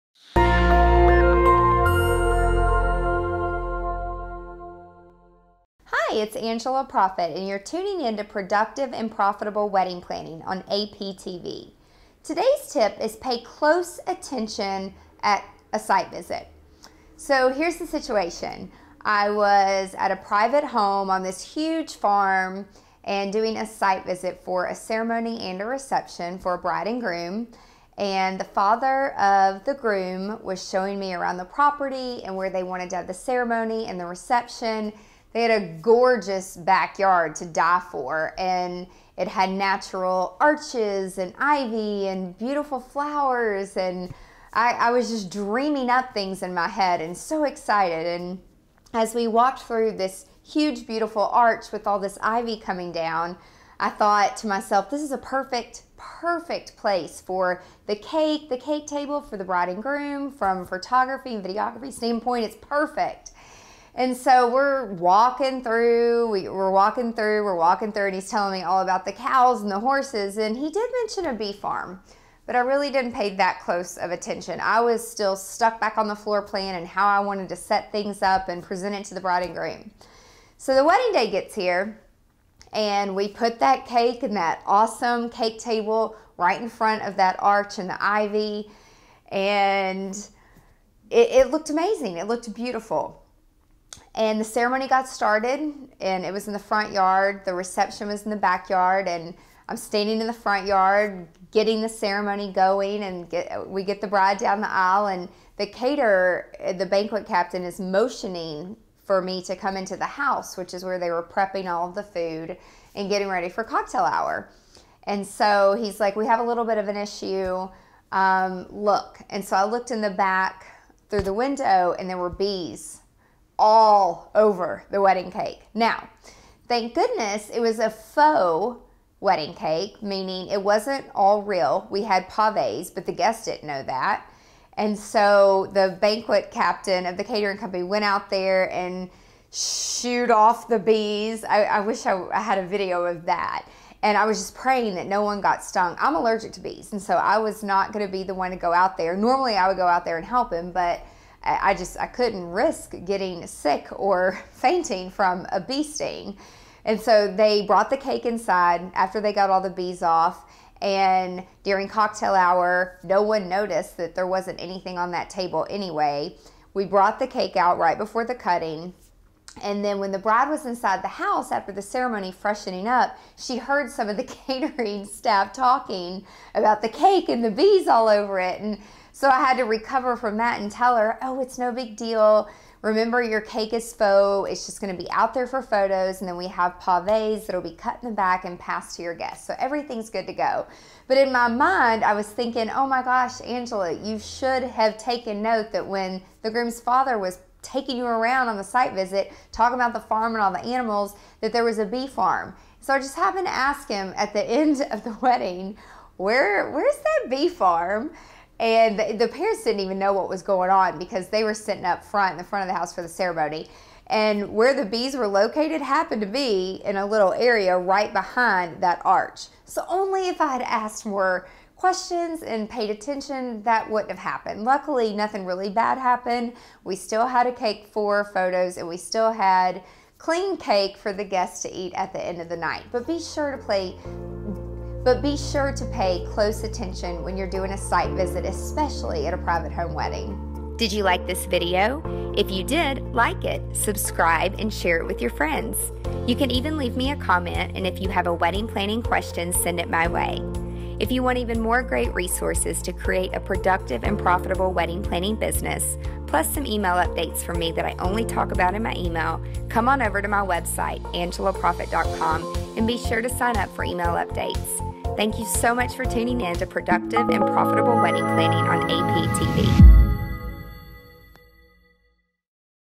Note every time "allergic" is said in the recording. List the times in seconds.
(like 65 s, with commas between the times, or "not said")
146 s.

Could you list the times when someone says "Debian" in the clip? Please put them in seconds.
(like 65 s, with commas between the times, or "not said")
not said.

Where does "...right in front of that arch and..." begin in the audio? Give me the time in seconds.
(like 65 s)
86 s.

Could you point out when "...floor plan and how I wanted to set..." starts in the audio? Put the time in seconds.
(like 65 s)
76 s.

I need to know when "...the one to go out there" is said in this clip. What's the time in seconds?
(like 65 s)
148 s.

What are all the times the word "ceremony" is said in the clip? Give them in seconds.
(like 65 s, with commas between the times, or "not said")
24 s, 33 s, 94 s, 101 s, 171 s, 213 s.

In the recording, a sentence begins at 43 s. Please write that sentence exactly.
And I, I was just dreaming up things in my head and so excited.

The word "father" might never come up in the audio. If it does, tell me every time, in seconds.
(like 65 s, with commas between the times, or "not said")
28 s, 196 s.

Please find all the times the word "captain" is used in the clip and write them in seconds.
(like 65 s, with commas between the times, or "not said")
107 s, 136 s.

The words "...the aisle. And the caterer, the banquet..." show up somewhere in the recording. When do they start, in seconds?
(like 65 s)
104 s.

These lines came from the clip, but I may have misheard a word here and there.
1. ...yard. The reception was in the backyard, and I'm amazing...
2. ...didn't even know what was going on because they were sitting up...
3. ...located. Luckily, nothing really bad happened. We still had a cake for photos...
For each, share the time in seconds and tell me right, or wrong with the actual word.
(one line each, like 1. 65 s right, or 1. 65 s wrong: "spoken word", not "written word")
1. 96 s wrong: "standing", not "amazing"
2. 209 s right
3. 224 s wrong: "happened", not "located".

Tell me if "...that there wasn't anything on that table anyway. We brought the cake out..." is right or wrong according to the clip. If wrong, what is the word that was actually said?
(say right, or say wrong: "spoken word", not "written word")
right.